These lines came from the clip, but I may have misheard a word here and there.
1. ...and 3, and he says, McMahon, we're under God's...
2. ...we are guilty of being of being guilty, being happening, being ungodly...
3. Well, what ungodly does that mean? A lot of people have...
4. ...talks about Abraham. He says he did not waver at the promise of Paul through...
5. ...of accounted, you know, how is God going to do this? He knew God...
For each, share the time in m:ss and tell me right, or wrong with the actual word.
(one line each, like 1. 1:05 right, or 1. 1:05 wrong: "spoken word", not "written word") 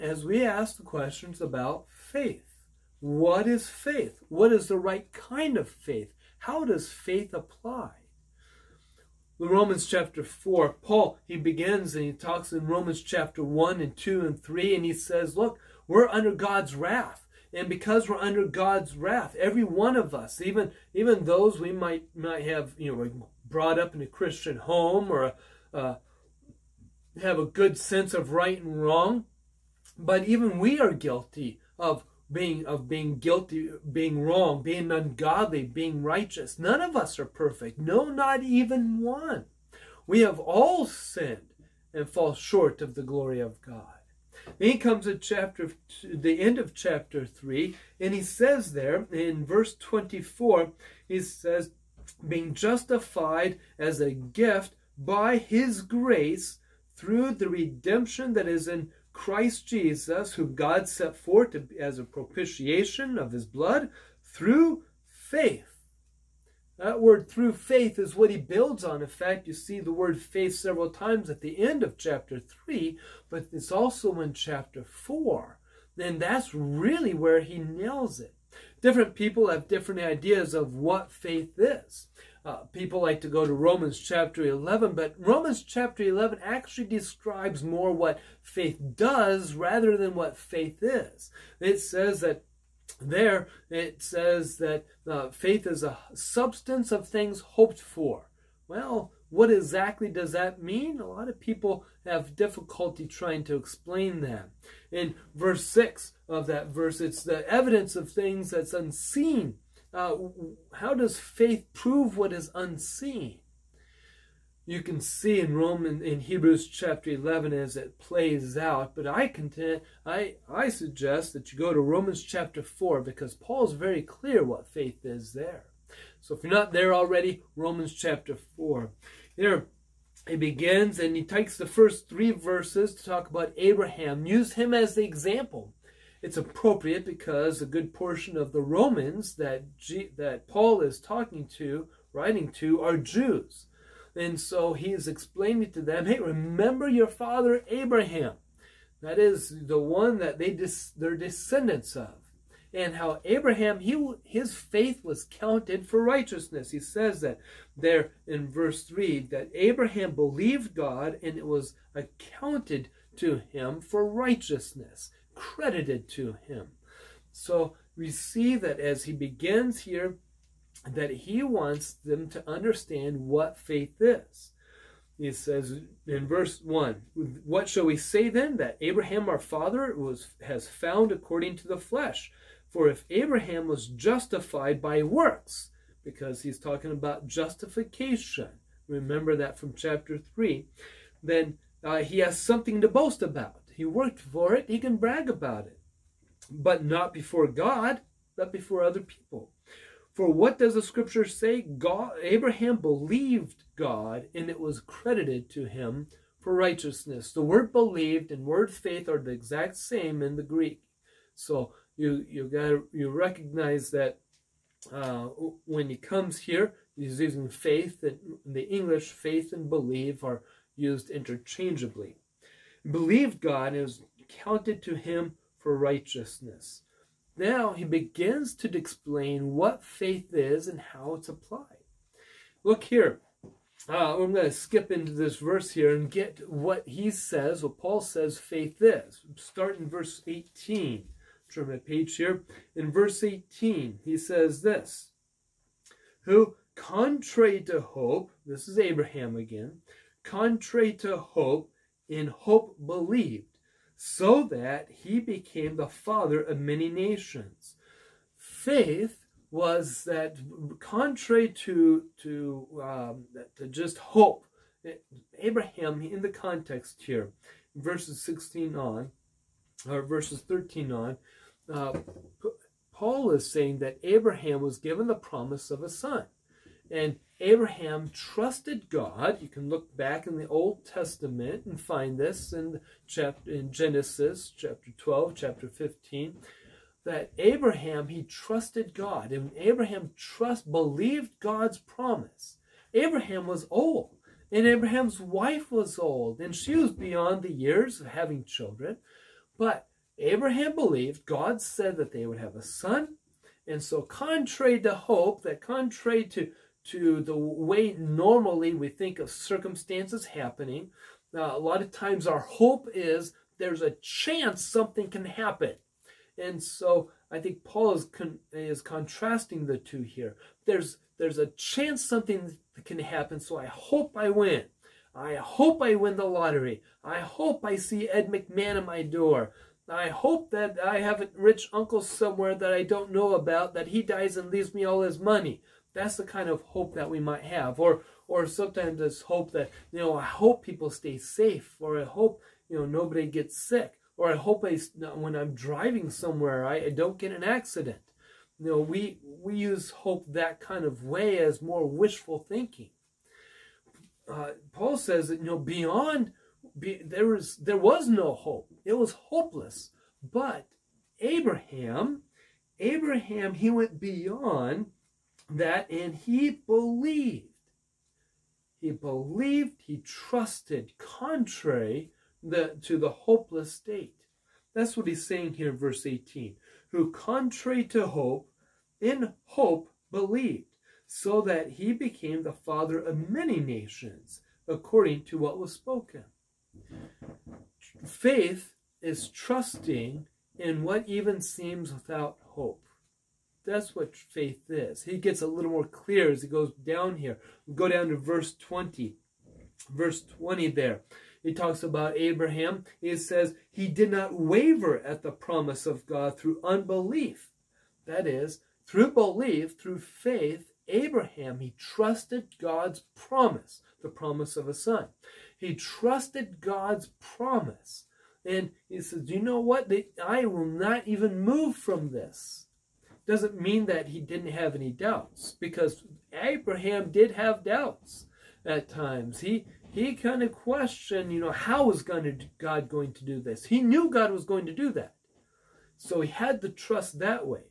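1. 0:14 wrong: "Look", not "McMahon"
2. 0:30 wrong: "wrong", not "happening"
3. 1:38 wrong: "exactly", not "ungodly"
4. 6:41 wrong: "God", not "Paul"
5. 7:10 wrong: "questioned", not "accounted".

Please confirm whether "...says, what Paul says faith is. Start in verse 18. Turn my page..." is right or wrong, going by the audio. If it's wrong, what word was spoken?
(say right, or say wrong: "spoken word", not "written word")
right.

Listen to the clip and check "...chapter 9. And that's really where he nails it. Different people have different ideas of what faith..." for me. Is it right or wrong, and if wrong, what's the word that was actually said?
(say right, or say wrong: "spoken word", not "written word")
wrong: "4", not "9".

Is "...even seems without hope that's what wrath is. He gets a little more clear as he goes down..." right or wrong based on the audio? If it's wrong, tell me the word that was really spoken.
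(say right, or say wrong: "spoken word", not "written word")
wrong: "faith", not "wrath".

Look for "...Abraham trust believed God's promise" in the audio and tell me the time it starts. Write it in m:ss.
4:49.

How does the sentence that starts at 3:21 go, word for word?
God, Abraham believed God, and it was credited to him for righteousness.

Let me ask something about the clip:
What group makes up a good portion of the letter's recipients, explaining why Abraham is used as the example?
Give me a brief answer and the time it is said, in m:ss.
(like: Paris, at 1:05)
Jews, at 2:22.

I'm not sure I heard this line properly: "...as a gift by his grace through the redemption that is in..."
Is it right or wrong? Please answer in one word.
right.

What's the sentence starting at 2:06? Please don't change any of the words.
So if you're not there already, Romans chapter 4.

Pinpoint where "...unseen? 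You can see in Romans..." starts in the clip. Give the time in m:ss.
1:52.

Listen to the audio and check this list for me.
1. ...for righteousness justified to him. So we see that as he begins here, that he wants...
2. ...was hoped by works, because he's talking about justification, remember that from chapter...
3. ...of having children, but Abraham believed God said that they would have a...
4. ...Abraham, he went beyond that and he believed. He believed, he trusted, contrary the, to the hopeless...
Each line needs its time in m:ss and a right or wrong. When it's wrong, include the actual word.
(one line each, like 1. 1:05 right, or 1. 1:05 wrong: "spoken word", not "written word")
1. 2:43 wrong: "credited", not "justified"
2. 3:03 wrong: "justified", not "hoped"
3. 4:58 right
4. 6:02 right.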